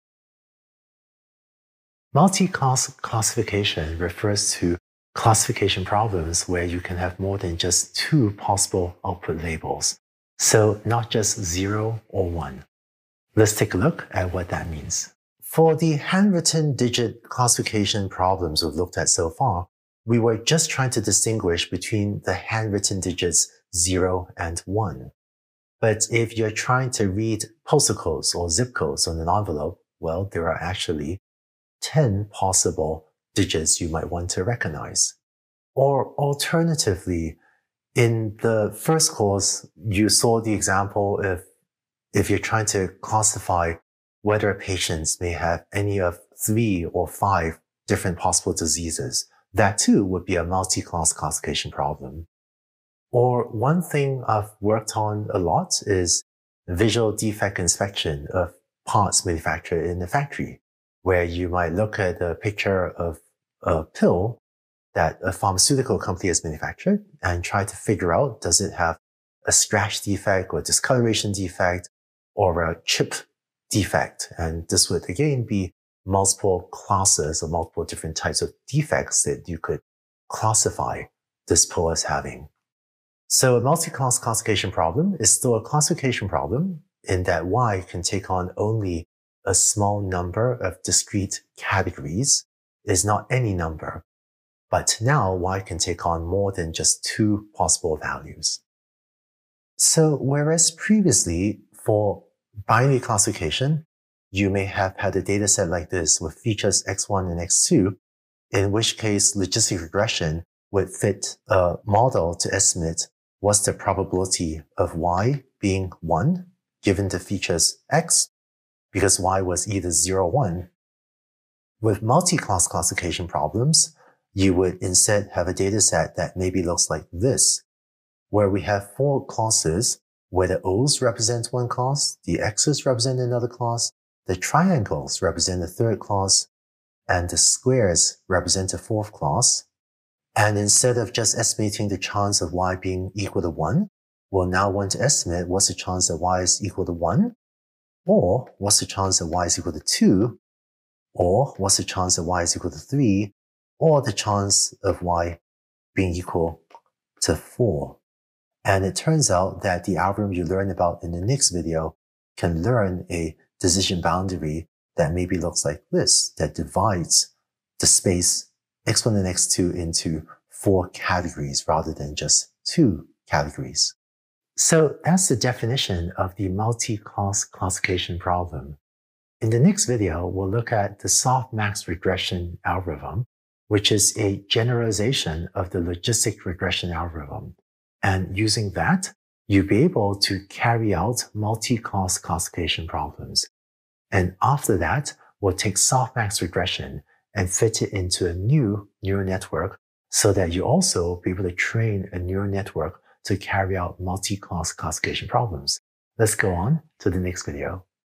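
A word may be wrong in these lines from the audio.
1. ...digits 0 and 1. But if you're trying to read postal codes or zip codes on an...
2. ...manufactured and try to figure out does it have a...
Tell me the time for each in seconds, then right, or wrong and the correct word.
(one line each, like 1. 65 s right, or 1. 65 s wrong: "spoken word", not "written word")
1. 22 s right
2. 66 s right.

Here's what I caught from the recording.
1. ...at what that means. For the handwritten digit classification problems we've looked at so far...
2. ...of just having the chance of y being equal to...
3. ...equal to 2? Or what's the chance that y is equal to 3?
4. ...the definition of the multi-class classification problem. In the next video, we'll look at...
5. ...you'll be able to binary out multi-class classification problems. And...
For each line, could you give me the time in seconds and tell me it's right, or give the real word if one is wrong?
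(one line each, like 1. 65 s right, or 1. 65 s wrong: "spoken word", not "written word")
1. 14 s right
2. 140 s wrong: "estimating", not "having"
3. 149 s right
4. 175 s right
5. 189 s wrong: "carry", not "binary".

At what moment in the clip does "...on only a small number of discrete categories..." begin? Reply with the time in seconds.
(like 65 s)
88 s.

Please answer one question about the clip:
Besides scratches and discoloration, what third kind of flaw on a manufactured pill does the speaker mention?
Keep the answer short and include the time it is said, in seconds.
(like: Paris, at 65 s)
chip defect, at 72 s.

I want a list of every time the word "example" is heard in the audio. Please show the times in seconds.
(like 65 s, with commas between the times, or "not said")
40 s.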